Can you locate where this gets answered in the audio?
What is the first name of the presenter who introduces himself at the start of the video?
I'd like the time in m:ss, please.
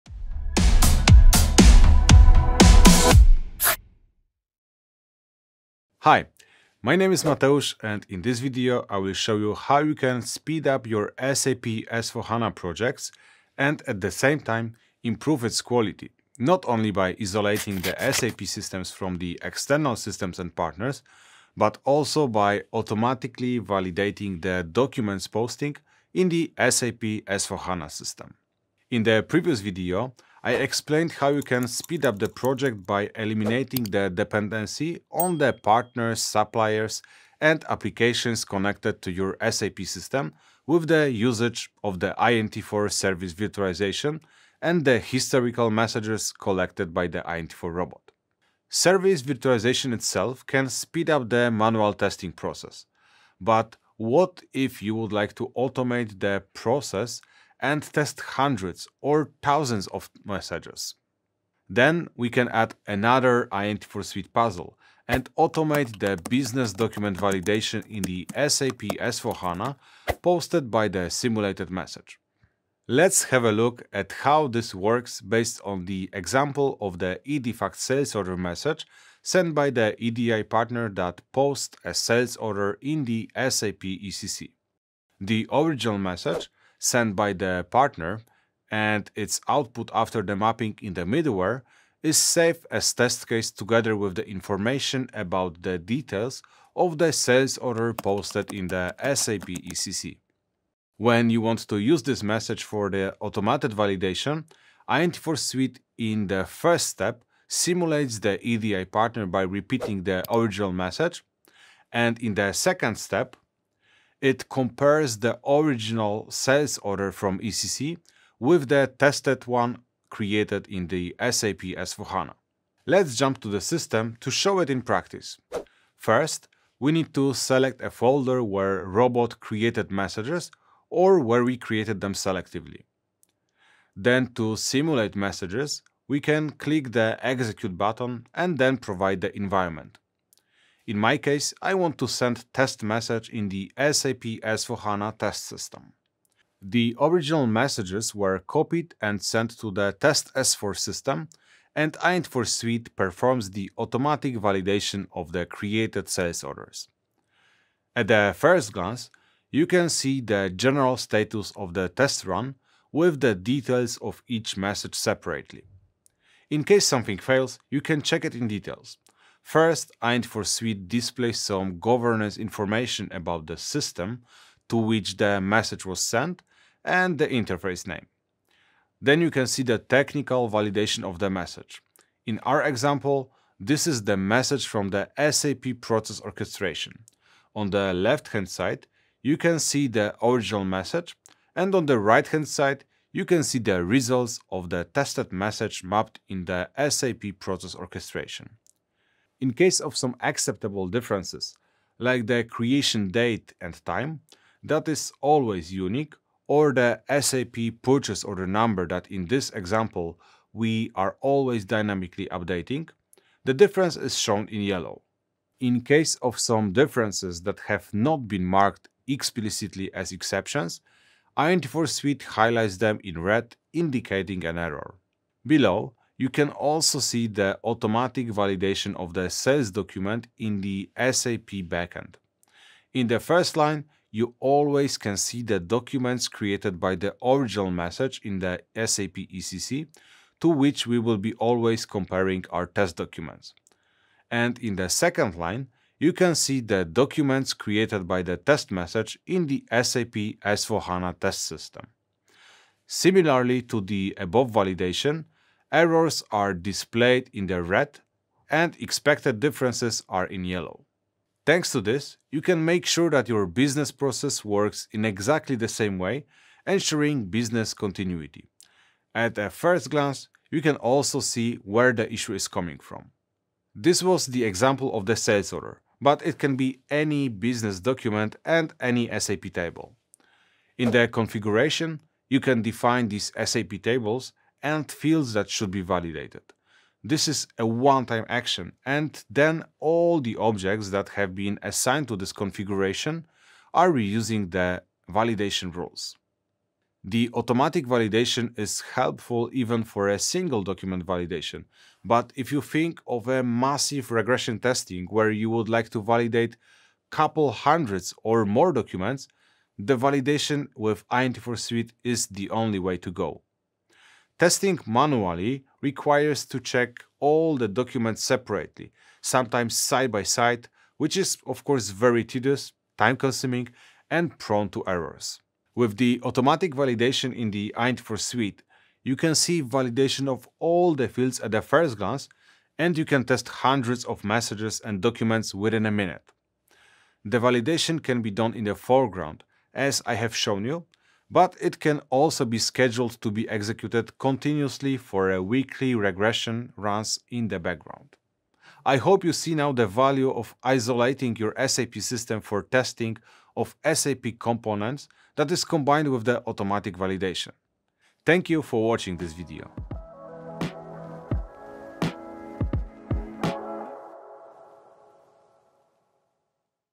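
0:07.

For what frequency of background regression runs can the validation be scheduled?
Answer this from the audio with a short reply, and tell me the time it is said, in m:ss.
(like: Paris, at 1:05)
Weekly, at 5:45.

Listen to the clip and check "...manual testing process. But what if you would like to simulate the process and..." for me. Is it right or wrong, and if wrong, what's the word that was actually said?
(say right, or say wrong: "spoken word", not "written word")
wrong: "automate", not "simulate".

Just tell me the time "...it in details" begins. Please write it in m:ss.
2:48.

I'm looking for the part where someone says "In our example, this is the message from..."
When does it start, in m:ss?
3:02.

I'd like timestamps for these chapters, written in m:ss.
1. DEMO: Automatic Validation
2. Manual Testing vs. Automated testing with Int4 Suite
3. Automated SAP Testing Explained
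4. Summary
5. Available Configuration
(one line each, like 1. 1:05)
1. 2:02
2. 5:13
3. 1:00
4. 5:49
5. 4:34.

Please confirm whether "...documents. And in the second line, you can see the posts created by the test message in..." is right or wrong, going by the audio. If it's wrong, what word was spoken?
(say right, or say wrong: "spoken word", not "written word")
wrong: "documents", not "posts".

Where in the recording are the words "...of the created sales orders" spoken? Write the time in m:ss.
2:35.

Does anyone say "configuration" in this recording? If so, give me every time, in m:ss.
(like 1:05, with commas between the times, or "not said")
4:41, 4:52.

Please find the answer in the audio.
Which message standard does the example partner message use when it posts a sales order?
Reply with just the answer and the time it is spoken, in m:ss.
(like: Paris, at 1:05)
EDIFACT, at 1:17.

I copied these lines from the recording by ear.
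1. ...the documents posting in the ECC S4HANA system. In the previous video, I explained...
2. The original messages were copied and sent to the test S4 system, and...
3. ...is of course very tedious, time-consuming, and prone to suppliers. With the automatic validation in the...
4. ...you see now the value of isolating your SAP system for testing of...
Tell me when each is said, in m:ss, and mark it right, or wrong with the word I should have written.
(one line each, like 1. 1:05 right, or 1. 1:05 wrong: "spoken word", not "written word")
1. 0:24 wrong: "SAP", not "ECC"
2. 2:26 right
3. 5:21 wrong: "errors", not "suppliers"
4. 5:49 right.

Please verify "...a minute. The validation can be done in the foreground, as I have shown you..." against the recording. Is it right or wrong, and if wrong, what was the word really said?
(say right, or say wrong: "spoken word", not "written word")
right.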